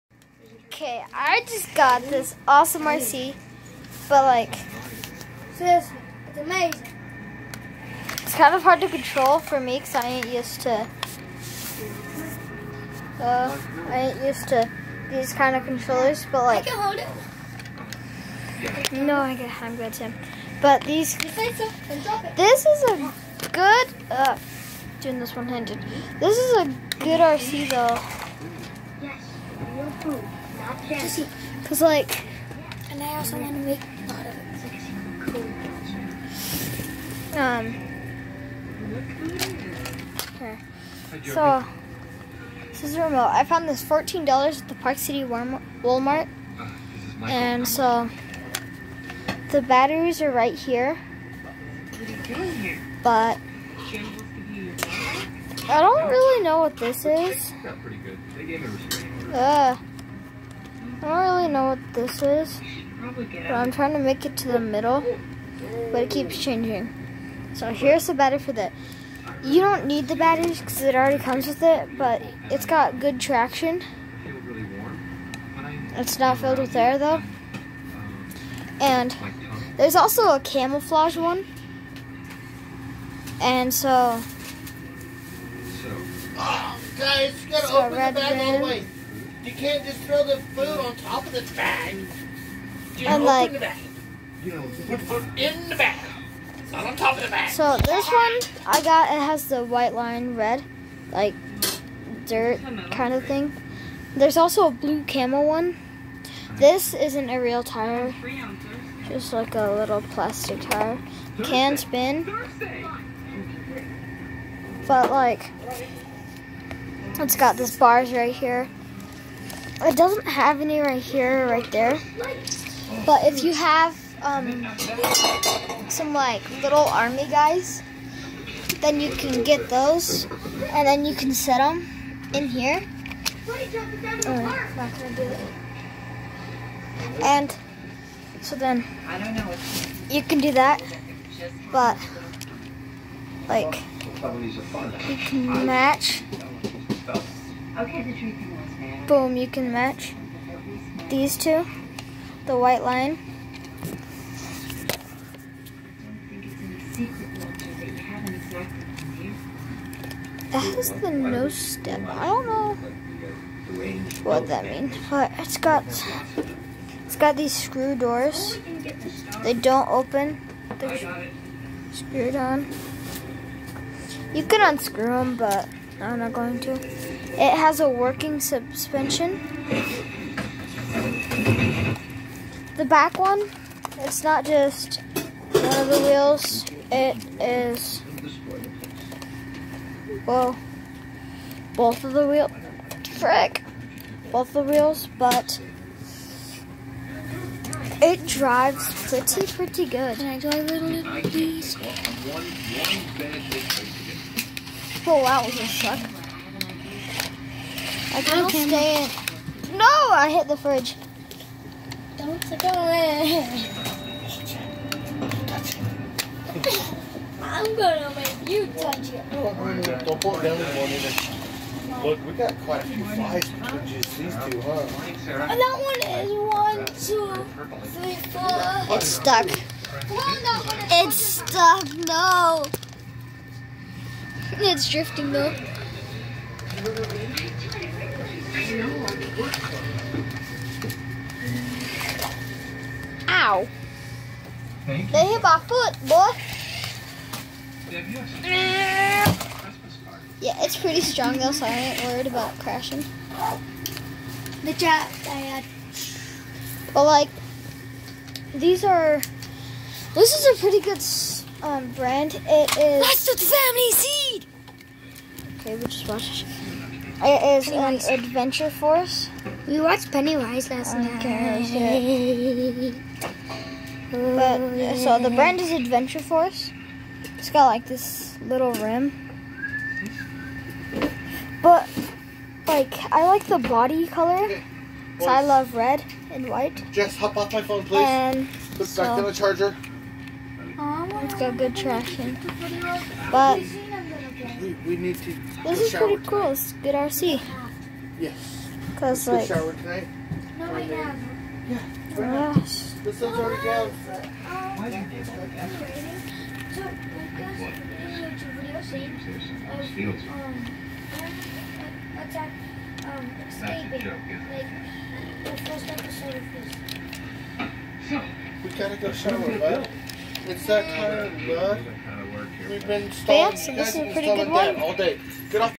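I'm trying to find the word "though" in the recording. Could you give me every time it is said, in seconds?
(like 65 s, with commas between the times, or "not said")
27 s, 76 s, 235 s, 251 s.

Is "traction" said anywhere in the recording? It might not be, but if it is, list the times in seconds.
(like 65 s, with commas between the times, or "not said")
73 s, 291 s.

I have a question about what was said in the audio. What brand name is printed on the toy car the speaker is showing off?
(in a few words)
Adventure Force.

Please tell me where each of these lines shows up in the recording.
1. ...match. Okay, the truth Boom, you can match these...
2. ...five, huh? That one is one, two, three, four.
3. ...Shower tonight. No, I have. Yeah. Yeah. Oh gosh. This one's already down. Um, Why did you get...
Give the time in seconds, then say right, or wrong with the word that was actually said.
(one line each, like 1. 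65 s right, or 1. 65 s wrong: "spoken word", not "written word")
1. 145 s right
2. 224 s wrong: "two", not "five"
3. 299 s right.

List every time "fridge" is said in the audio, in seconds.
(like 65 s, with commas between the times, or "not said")
210 s.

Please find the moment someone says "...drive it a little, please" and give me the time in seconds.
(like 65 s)
200 s.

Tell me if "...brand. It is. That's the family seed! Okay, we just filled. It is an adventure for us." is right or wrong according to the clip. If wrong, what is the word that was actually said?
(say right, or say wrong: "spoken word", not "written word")
wrong: "watched", not "filled".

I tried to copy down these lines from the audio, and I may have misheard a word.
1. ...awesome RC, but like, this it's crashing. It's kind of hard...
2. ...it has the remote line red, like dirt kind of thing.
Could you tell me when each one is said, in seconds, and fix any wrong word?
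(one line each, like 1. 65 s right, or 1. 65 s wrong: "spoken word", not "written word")
1. 2 s wrong: "amazing", not "crashing"
2. 99 s wrong: "white", not "remote".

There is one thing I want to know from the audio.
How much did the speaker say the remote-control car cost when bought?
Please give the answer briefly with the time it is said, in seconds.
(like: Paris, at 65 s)
$14, at 43 s.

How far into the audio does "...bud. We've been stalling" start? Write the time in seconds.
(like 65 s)
321 s.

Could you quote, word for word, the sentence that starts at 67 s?
So here's the battery for that.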